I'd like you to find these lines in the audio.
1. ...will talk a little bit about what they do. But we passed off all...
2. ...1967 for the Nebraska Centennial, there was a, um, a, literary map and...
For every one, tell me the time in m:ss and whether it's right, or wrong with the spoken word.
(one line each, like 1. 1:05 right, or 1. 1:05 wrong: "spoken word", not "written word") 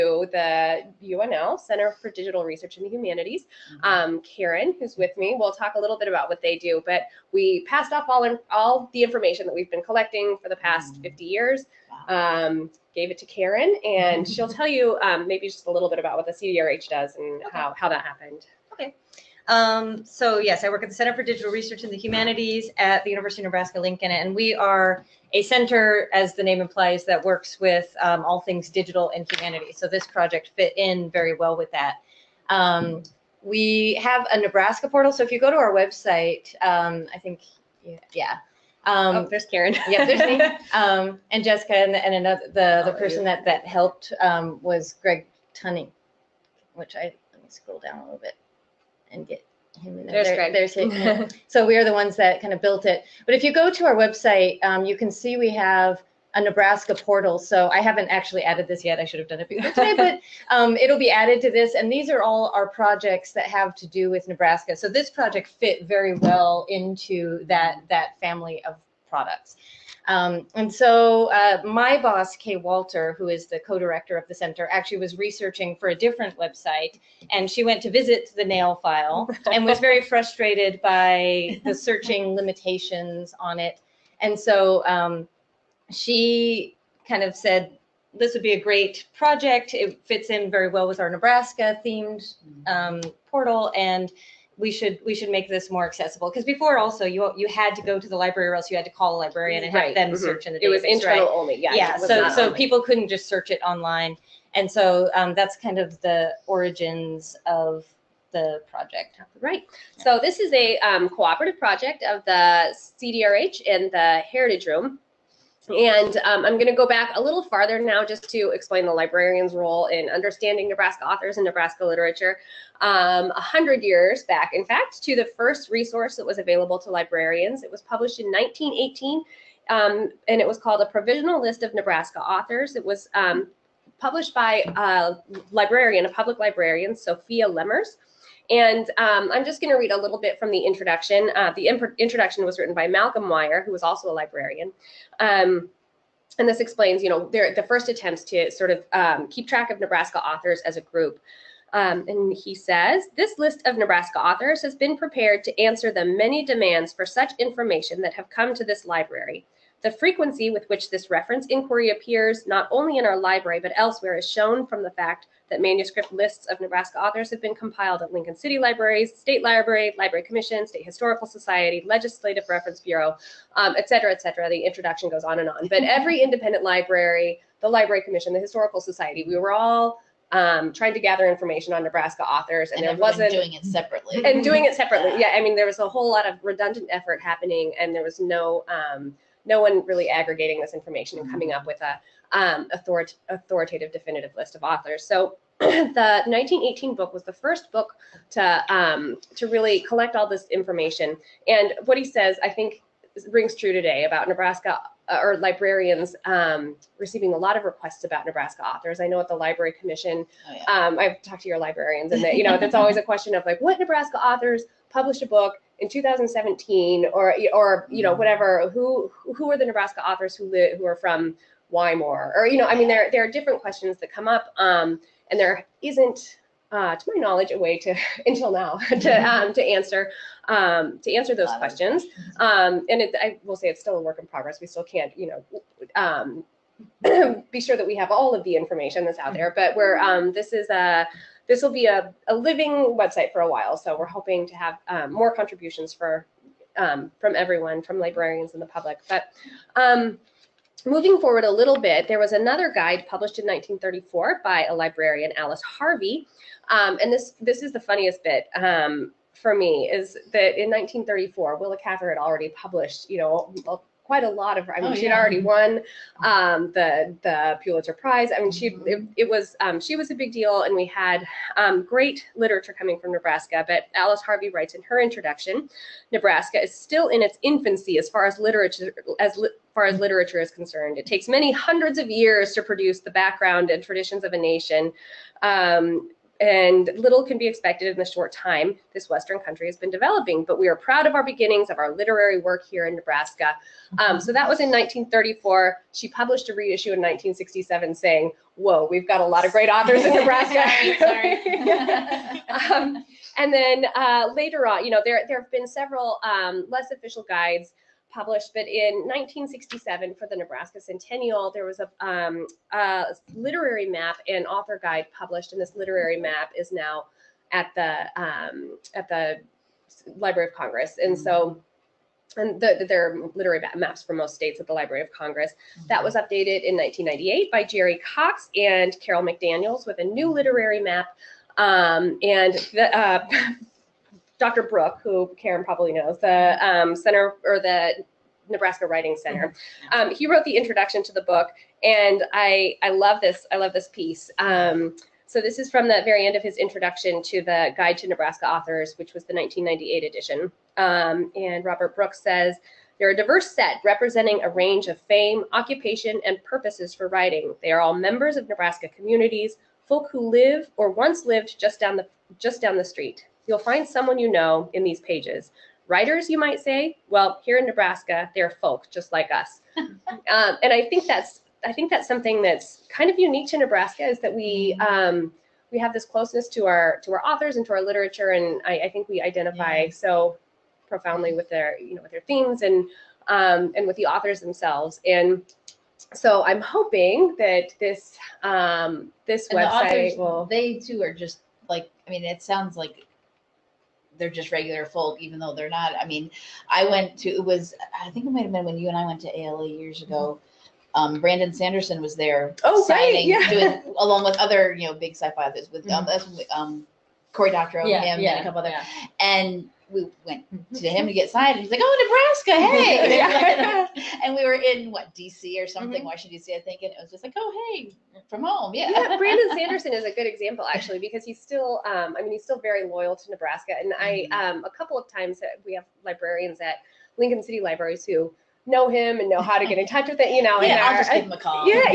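1. 0:05 right
2. 5:09 right.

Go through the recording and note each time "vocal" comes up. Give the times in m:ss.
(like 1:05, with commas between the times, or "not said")
not said.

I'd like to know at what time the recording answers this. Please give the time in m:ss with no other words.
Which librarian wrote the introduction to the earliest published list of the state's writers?
2:22.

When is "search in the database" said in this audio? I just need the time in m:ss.
1:40.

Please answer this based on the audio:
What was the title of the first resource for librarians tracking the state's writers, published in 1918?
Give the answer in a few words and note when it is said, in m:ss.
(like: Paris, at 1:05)
A Provisional List of Nebraska Authors, at 2:10.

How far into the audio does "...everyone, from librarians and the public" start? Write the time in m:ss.
4:07.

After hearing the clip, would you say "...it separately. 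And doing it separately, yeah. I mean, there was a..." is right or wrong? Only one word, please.
right.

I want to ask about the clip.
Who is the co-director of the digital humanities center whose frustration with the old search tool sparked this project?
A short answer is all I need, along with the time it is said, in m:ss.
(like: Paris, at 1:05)
Kay Walter, at 1:12.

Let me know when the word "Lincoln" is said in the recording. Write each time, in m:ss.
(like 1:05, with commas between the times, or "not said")
0:23, 2:48, 7:07.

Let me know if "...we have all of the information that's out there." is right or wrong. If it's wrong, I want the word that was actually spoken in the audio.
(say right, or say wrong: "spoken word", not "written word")
right.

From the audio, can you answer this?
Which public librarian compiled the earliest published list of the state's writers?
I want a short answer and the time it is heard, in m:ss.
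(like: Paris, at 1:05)
Sophia Lemmers, at 2:16.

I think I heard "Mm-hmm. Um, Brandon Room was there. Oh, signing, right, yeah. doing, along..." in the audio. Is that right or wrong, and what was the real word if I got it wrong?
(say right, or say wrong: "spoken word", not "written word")
wrong: "Sanderson", not "Room".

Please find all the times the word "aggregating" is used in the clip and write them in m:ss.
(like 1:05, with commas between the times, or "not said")
3:10.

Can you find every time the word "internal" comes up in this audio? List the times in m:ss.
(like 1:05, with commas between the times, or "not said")
1:40.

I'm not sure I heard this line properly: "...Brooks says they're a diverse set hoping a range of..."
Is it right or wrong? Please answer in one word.
wrong.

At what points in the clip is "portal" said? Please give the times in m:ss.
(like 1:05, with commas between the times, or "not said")
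0:34, 0:56, 1:33.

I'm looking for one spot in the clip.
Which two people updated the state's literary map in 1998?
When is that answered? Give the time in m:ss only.
5:27.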